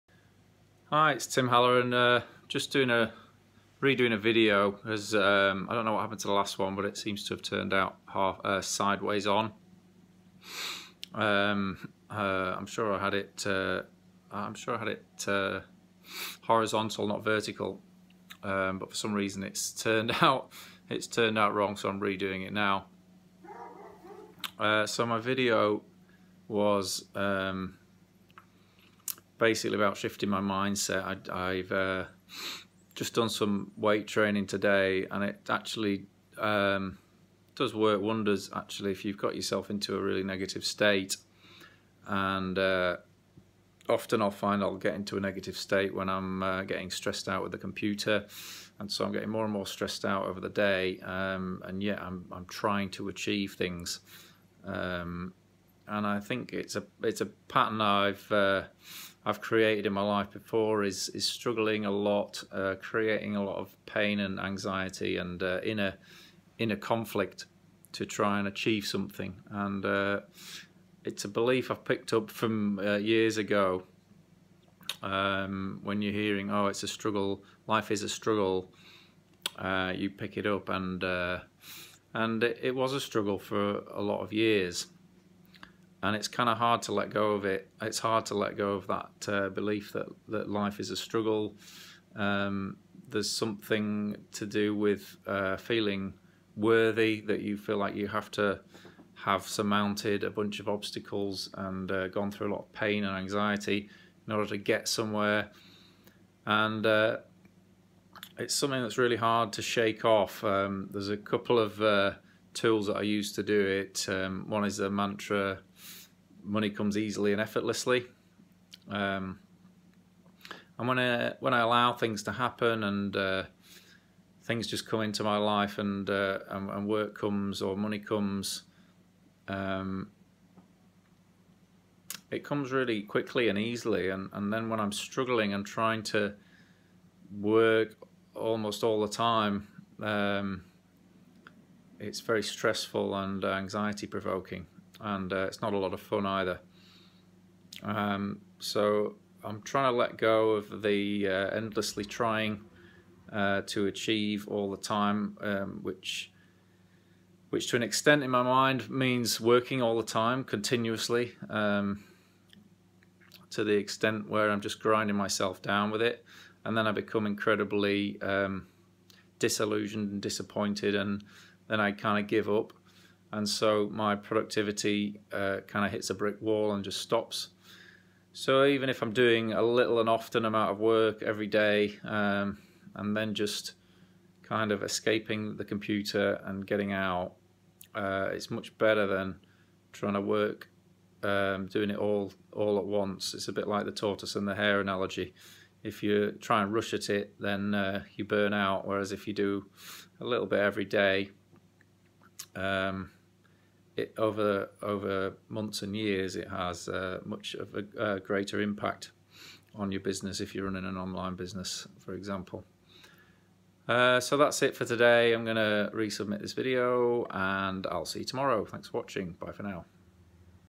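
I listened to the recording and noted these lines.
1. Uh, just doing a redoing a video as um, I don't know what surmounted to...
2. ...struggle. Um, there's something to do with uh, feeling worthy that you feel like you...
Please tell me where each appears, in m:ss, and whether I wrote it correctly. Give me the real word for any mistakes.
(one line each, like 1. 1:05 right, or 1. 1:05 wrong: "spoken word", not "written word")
1. 0:01 wrong: "happened", not "surmounted"
2. 1:30 right.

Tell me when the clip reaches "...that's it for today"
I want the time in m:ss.
3:34.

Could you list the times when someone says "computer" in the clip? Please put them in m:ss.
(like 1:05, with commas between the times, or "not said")
0:47, 3:05.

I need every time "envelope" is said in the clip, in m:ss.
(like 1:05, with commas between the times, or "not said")
not said.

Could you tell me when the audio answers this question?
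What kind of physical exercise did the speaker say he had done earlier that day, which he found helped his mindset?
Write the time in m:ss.
0:33.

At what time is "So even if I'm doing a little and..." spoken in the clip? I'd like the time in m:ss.
2:58.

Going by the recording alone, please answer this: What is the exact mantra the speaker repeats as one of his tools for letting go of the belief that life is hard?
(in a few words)
Money comes easily and effortlessly.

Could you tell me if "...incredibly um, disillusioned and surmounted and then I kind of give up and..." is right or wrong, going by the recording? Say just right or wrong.
wrong.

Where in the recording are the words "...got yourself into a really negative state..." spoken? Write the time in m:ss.
0:39.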